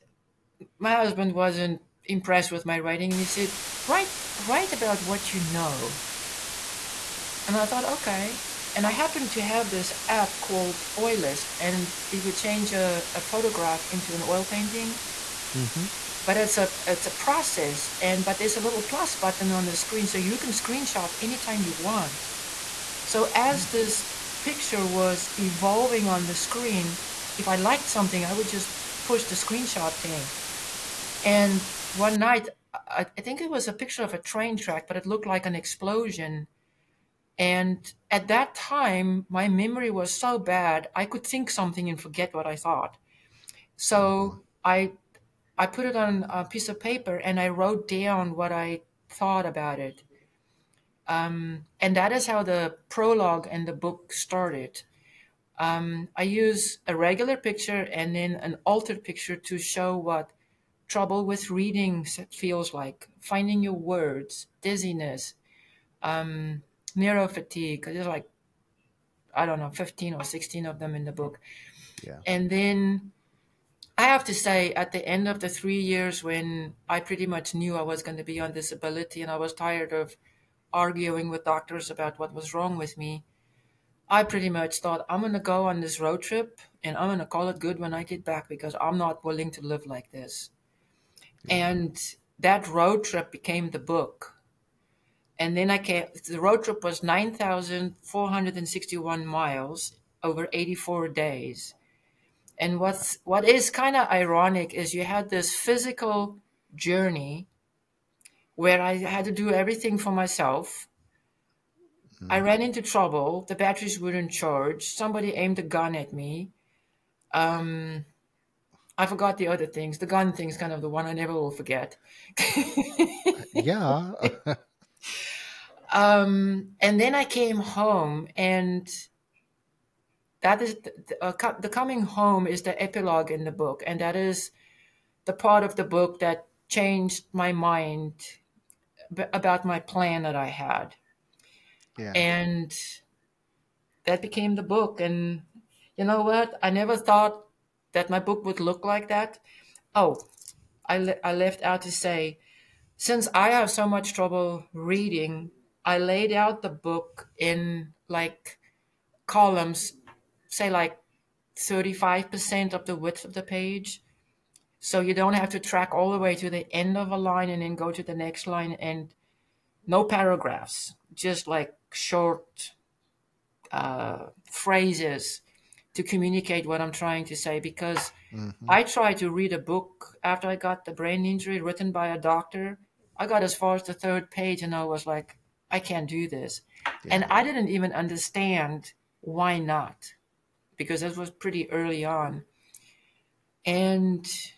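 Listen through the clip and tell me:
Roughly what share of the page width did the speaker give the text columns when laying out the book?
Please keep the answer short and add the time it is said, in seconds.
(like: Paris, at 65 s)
35%, at 161 s.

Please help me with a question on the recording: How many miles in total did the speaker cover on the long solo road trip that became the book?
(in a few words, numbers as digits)
9,461 miles.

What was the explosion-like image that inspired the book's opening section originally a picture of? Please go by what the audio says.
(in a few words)
A train track.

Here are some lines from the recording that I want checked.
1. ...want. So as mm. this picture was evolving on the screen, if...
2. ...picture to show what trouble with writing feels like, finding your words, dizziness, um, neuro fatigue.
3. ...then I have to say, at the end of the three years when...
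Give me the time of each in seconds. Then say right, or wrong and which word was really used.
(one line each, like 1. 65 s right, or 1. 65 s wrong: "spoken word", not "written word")
1. 21 s right
2. 59 s wrong: "reading", not "writing"
3. 72 s right.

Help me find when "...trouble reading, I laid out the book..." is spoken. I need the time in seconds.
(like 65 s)
154 s.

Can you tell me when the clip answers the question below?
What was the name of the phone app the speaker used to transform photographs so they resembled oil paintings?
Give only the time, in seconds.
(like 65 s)
10 s.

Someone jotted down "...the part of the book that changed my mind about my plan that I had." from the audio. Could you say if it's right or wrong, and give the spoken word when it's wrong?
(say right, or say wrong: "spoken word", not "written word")
right.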